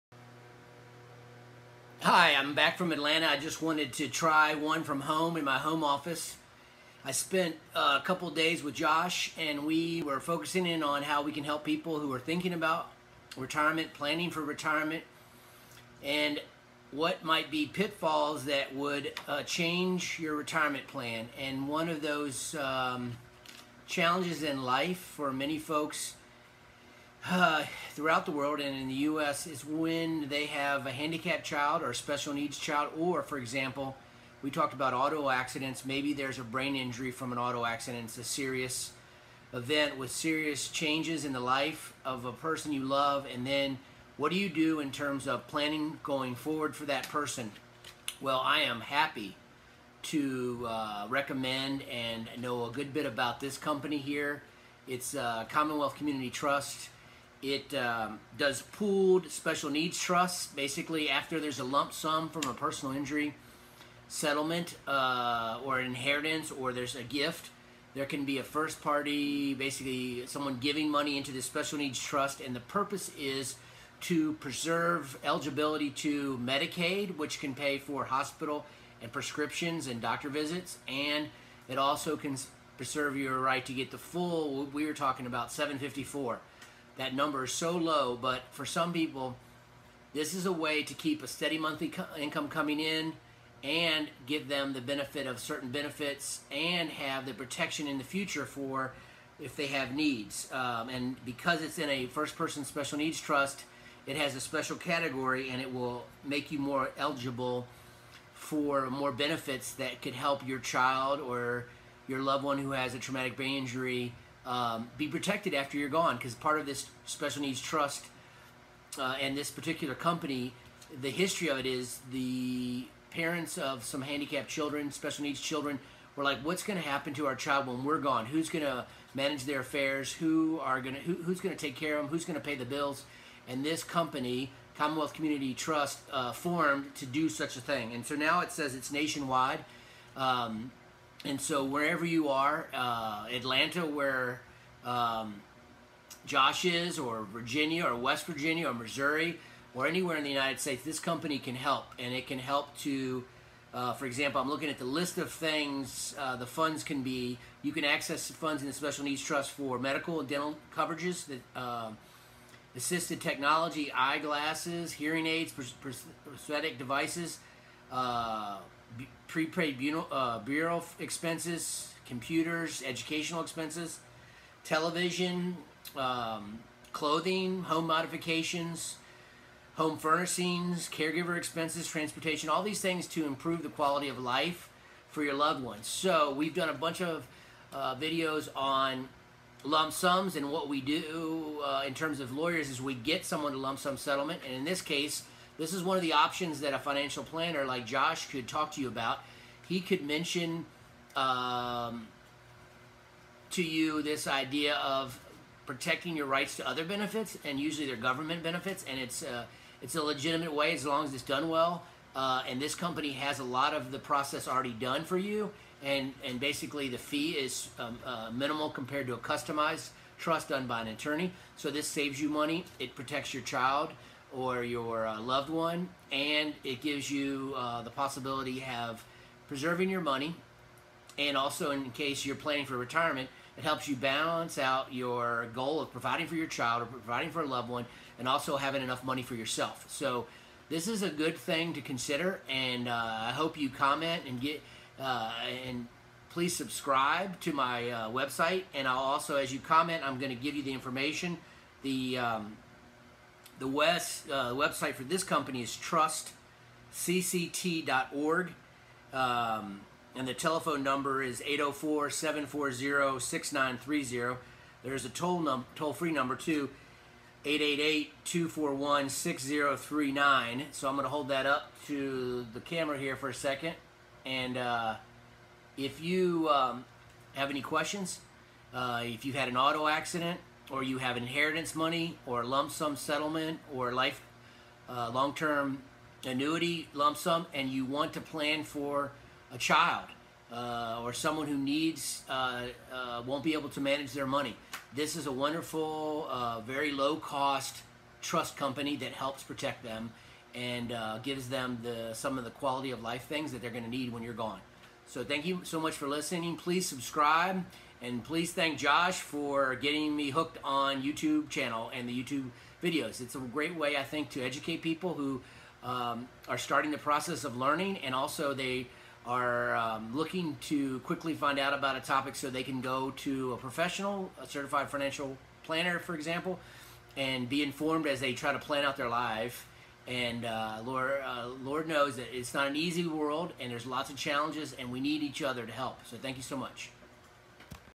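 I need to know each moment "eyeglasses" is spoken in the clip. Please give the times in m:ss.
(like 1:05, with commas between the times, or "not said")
2:43.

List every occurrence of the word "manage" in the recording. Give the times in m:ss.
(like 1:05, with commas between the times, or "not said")
2:09, 4:53.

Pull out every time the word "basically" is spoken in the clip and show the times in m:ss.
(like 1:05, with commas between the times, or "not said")
1:00, 1:09, 3:36.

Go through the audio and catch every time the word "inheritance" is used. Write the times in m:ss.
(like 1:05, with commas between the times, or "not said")
1:05, 4:41.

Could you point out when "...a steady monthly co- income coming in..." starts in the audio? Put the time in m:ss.
1:31.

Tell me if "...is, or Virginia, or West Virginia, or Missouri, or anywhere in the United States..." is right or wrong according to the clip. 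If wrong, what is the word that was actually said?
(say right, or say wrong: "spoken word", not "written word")
right.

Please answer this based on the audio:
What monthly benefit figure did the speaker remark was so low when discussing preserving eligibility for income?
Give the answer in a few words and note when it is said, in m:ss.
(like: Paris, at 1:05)
754, at 1:25.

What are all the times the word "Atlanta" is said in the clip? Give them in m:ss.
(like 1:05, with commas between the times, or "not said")
0:02, 2:23.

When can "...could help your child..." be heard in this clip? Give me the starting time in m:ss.
1:50.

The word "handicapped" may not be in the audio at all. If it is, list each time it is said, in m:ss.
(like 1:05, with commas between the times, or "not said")
0:30, 2:04.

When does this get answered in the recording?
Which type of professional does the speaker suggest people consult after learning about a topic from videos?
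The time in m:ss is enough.
5:24.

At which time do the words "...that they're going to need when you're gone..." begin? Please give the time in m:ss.
5:03.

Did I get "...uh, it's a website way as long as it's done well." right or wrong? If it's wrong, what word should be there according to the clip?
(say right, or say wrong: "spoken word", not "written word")
wrong: "legitimate", not "website".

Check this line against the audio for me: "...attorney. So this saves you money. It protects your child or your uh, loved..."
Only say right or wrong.
right.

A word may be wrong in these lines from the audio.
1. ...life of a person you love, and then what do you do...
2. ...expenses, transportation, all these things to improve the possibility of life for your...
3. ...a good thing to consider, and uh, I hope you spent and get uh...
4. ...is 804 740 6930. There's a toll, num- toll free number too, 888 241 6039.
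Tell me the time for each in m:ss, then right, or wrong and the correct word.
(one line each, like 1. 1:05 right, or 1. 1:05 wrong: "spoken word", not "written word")
1. 0:41 right
2. 3:01 wrong: "quality", not "possibility"
3. 4:01 wrong: "comment", not "spent"
4. 4:21 right.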